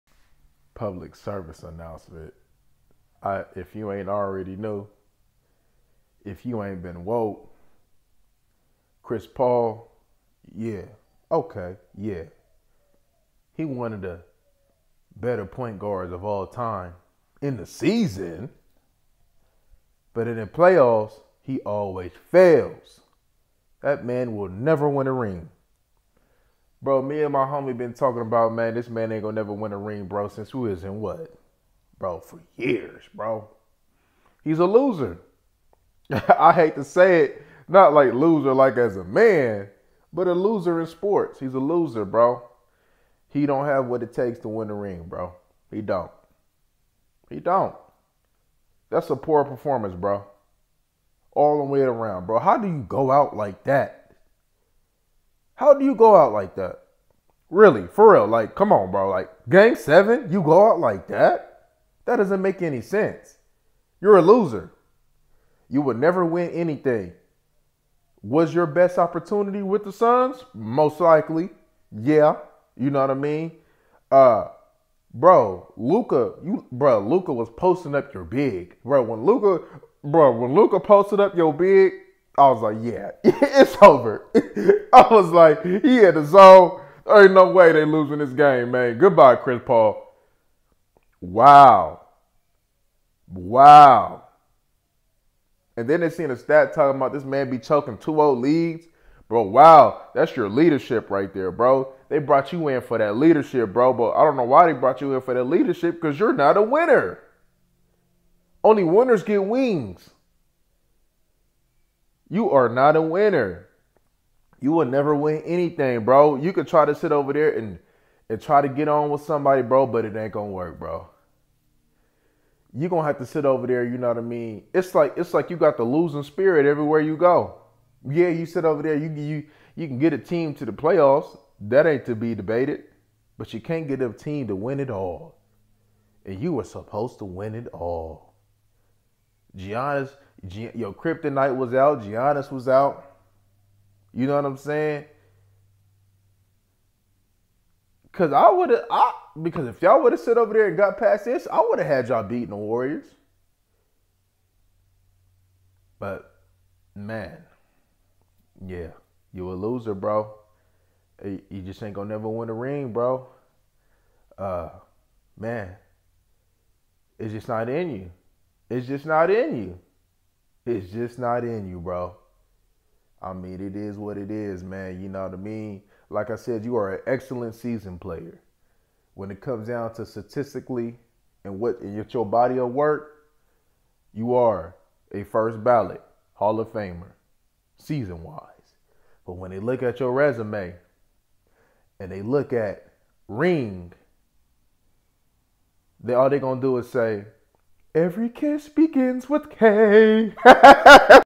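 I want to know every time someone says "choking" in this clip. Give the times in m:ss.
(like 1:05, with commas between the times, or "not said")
1:37.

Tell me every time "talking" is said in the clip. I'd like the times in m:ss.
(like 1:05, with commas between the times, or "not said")
0:27, 1:36.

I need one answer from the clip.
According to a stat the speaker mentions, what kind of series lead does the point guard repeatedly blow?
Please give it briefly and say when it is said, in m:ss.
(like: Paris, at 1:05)
2-0 leads, at 1:37.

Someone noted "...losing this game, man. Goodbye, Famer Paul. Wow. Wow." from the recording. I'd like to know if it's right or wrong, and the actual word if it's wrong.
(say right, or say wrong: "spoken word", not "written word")
wrong: "Chris", not "Famer".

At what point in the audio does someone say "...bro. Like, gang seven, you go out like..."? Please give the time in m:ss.
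0:58.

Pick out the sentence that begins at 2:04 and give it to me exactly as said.
It's like it's like you got the losing spirit everywhere you go.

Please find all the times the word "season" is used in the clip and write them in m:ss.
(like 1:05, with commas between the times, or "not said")
0:17, 2:57, 3:07.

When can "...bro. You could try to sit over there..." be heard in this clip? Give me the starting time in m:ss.
1:56.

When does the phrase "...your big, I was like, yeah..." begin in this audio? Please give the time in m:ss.
1:21.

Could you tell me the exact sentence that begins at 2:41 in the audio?
You just ain't gonna never win a ring, bro.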